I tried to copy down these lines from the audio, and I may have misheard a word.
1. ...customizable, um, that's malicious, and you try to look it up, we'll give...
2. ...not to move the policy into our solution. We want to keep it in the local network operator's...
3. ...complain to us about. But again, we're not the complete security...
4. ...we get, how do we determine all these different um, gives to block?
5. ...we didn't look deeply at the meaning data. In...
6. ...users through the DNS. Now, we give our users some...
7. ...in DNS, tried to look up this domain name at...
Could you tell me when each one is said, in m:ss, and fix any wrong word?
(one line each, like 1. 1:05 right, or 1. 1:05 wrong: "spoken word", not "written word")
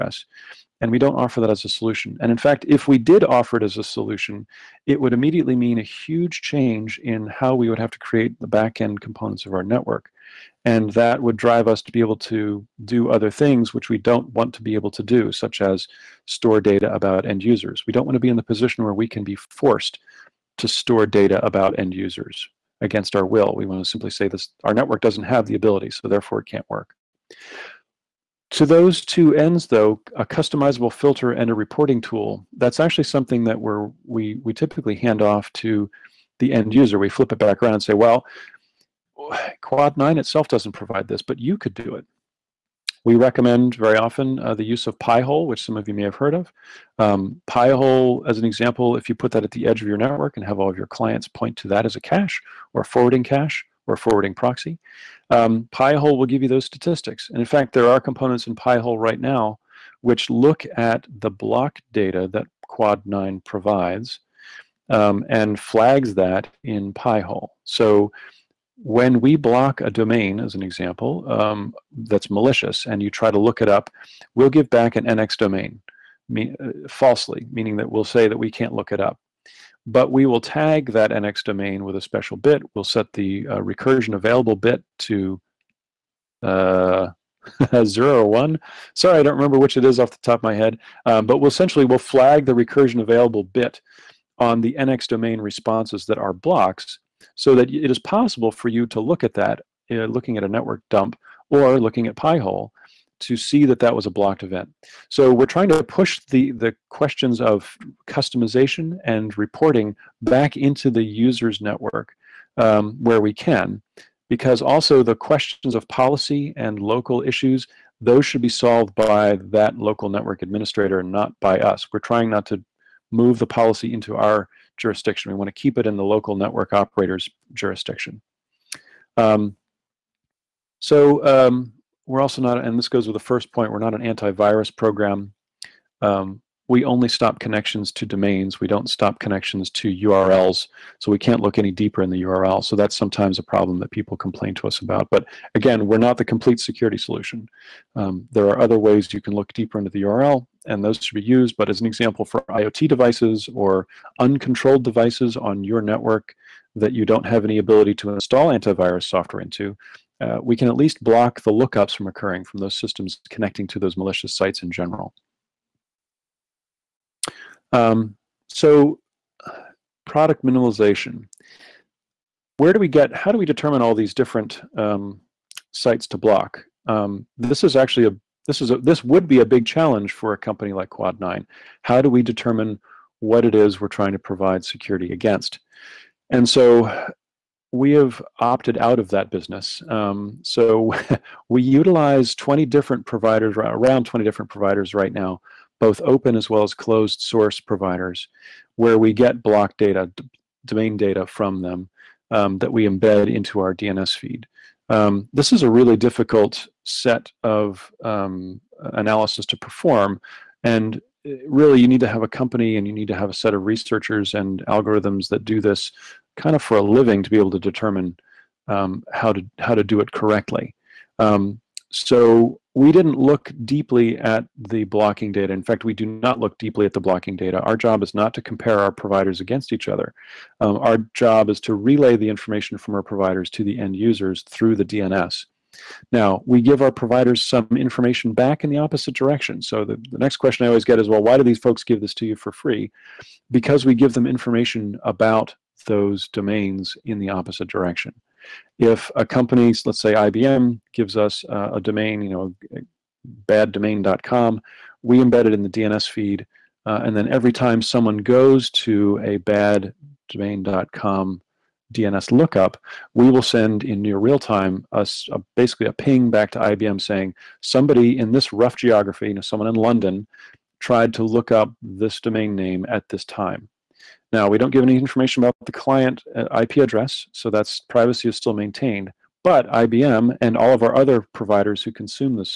1. 1:10 wrong: "example", not "customizable"
2. 2:02 wrong: "jurisdiction", not "solution"
3. 2:24 right
4. 2:52 wrong: "sites", not "gives"
5. 3:42 wrong: "blocking", not "meaning"
6. 3:53 wrong: "providers", not "users"
7. 4:29 wrong: "London", not "DNS".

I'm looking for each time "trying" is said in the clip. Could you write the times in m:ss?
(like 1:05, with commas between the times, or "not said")
1:45, 2:01, 3:03.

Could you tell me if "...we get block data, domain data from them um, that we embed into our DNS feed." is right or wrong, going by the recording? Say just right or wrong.
right.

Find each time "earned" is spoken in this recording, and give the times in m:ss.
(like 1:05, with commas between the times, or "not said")
not said.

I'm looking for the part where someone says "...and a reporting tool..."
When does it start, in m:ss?
0:31.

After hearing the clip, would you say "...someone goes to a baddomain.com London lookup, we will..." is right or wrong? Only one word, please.
wrong.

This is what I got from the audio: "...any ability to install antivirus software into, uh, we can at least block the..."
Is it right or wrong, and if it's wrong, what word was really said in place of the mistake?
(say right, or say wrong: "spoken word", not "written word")
right.